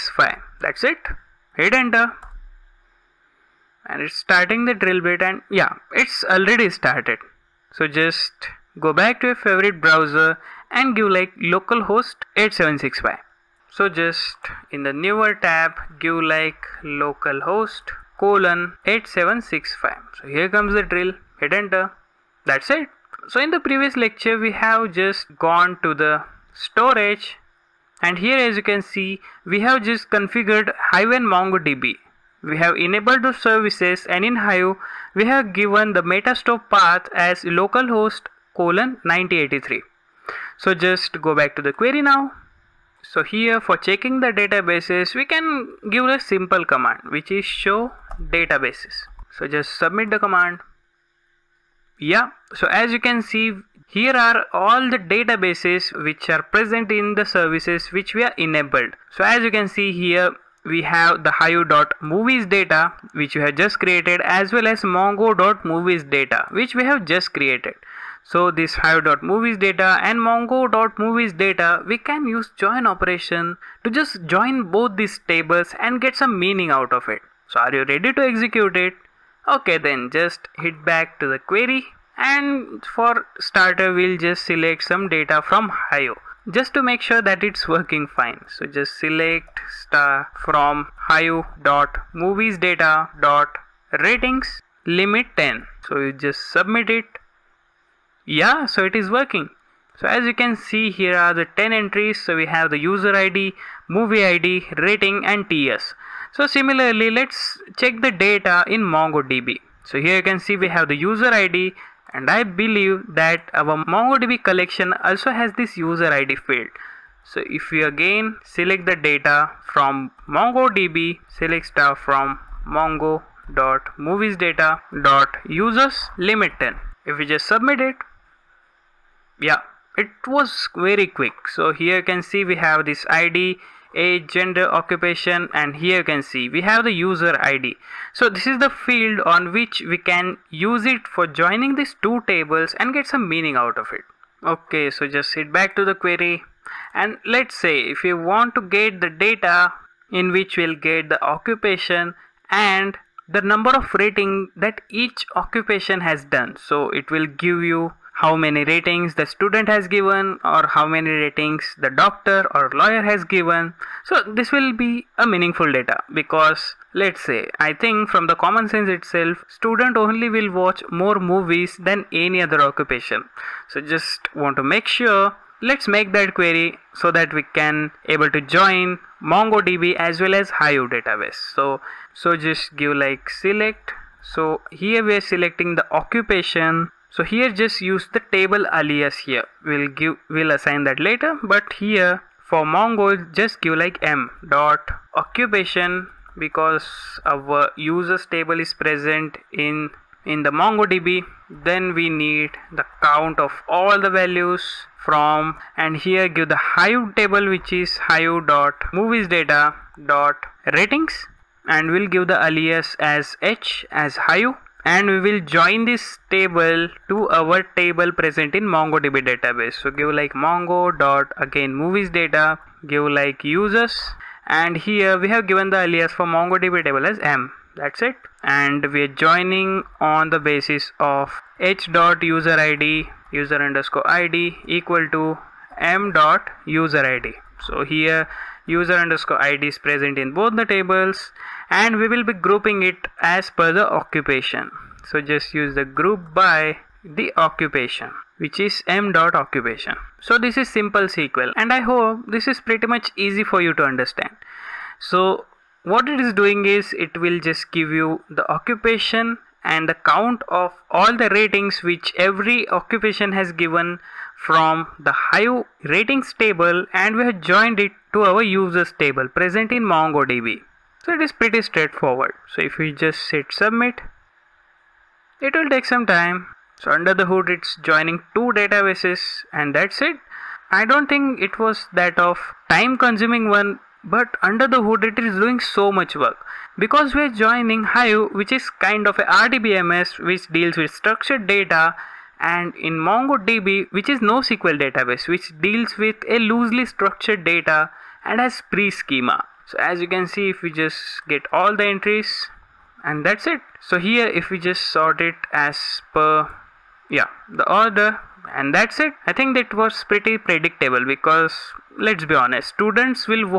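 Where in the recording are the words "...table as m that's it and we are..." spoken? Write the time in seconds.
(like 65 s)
226 s.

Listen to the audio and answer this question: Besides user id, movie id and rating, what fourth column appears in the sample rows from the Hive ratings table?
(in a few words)
ts.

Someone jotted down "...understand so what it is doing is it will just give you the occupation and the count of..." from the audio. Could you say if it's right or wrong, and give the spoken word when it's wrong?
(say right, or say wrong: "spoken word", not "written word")
right.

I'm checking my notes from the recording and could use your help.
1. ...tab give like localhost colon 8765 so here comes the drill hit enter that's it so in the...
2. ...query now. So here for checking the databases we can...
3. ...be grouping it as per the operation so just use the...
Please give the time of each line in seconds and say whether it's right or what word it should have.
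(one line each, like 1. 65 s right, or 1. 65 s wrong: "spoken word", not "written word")
1. 15 s right
2. 41 s right
3. 242 s wrong: "occupation", not "operation".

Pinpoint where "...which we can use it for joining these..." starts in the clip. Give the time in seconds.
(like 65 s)
139 s.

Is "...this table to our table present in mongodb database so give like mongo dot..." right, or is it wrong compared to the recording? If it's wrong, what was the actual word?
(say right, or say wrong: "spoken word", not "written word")
right.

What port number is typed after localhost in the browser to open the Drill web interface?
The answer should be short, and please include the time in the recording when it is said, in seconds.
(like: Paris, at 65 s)
8765, at 11 s.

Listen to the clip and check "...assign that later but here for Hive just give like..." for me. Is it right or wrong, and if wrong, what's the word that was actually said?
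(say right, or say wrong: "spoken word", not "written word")
wrong: "Mongo", not "Hive".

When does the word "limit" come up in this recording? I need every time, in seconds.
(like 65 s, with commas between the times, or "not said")
94 s, 126 s.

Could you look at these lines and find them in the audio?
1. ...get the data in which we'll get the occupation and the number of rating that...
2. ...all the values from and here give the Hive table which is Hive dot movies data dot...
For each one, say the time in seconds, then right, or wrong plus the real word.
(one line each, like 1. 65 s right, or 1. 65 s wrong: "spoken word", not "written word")
1. 148 s right
2. 203 s right.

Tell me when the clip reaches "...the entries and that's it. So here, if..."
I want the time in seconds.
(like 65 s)
301 s.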